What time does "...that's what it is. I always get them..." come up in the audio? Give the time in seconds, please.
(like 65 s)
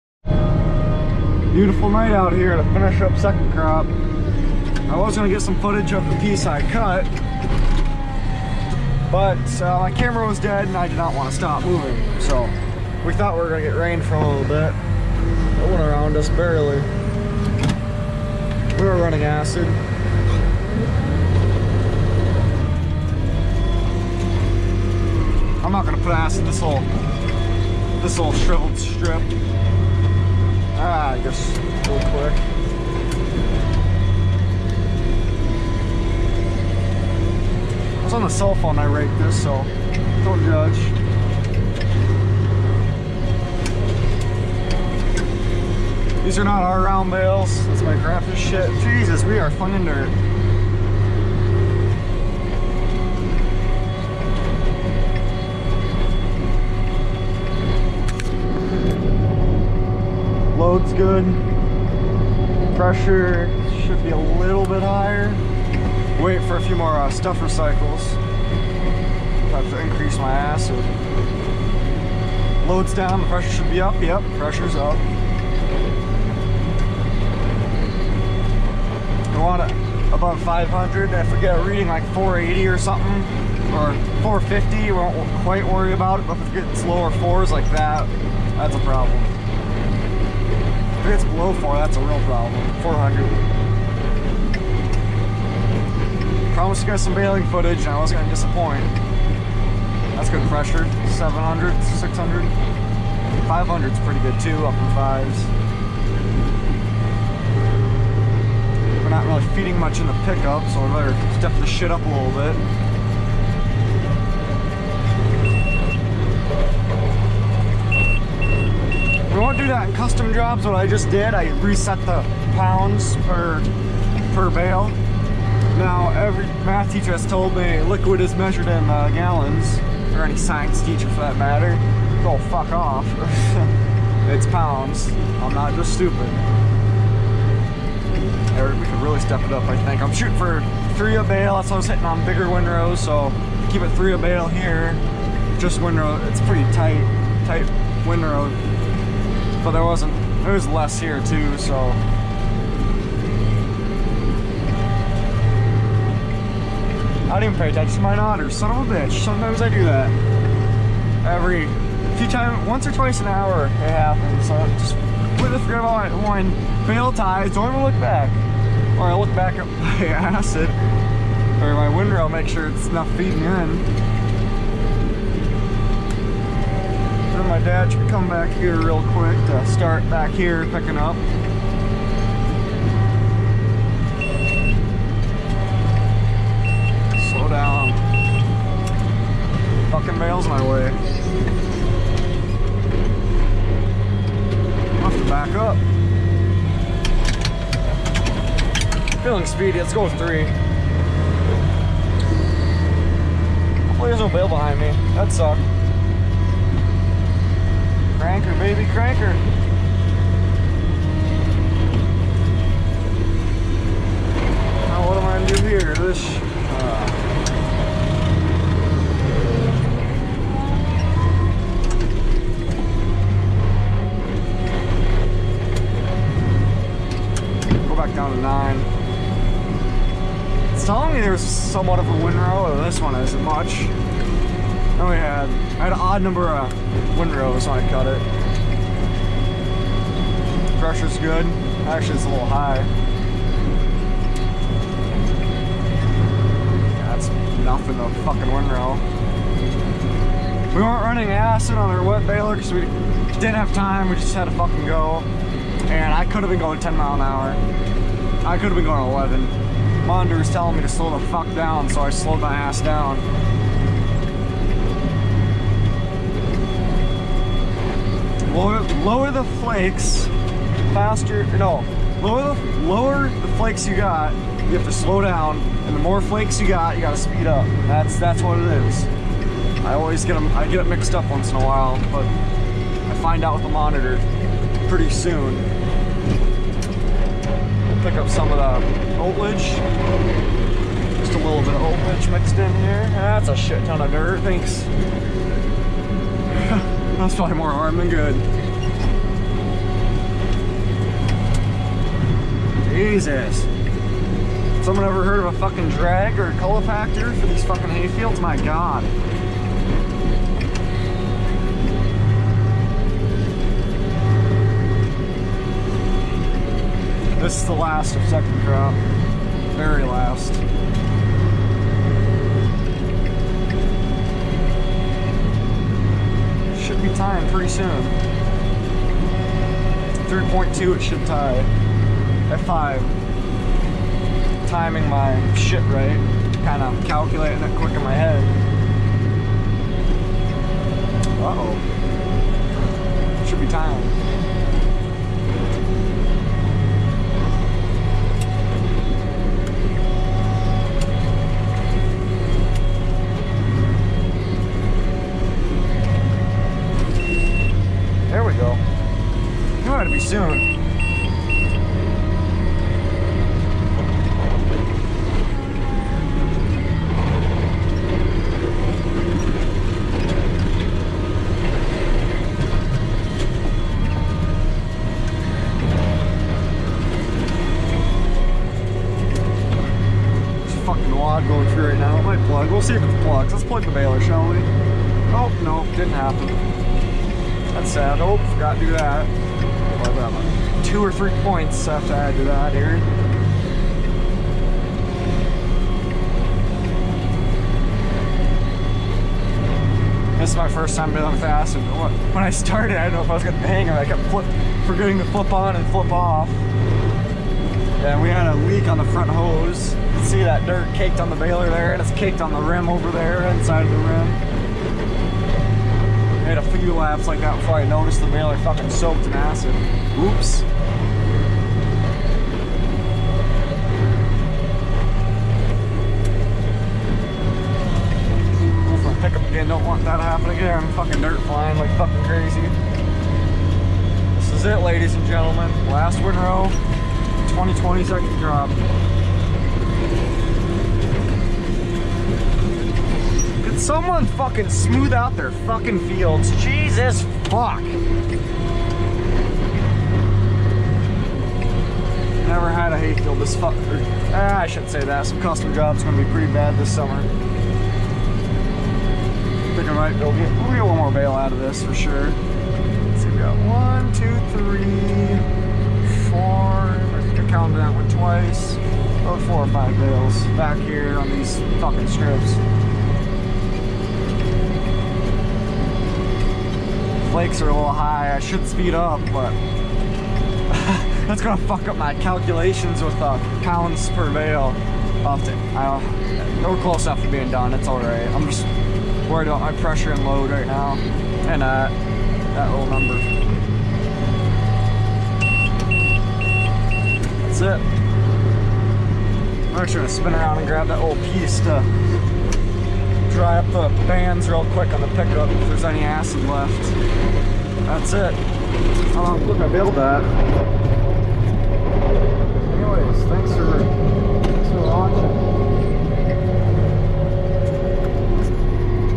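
278 s.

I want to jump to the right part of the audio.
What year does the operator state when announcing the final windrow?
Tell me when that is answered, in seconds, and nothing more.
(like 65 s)
437 s.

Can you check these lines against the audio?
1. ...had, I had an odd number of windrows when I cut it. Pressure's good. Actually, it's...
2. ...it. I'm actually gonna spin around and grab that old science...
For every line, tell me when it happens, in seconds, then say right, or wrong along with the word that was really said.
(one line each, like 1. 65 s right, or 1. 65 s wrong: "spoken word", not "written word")
1. 235 s right
2. 497 s wrong: "piece", not "science".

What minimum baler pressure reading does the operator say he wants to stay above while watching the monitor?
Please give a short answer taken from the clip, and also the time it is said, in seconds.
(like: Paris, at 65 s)
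500, at 79 s.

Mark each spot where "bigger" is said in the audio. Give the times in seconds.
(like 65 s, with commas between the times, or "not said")
142 s.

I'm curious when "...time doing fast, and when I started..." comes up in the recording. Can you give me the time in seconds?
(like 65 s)
400 s.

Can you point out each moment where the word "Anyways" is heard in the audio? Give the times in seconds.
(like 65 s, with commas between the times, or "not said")
512 s.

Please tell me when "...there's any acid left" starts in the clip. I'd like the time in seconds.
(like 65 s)
505 s.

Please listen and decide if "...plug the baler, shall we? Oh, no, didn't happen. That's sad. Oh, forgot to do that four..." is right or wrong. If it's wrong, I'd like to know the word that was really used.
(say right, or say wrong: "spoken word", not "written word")
wrong: "two", not "four".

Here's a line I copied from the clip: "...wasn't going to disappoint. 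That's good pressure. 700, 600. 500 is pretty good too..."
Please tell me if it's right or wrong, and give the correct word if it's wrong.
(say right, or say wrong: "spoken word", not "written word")
right.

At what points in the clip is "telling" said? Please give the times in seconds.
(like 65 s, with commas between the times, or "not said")
230 s, 260 s.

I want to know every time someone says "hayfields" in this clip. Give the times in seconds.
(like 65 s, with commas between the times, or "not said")
307 s, 452 s.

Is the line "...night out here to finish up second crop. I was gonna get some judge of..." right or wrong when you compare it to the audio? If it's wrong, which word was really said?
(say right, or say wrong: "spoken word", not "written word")
wrong: "footage", not "judge".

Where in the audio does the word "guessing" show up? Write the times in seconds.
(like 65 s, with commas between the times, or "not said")
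not said.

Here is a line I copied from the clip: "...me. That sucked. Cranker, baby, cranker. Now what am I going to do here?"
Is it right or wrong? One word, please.
right.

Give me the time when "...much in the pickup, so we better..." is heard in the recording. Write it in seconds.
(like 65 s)
109 s.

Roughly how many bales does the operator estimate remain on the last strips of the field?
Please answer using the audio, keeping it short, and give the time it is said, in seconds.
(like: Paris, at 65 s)
4 or 5, at 469 s.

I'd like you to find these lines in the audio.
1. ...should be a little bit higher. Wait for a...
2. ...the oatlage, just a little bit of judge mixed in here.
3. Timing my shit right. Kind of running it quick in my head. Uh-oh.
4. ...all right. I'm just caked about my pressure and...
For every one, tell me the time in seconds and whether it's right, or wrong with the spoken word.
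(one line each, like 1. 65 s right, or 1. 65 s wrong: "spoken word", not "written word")
1. 63 s right
2. 288 s wrong: "oatlage", not "judge"
3. 334 s wrong: "calculating", not "running"
4. 487 s wrong: "worried", not "caked".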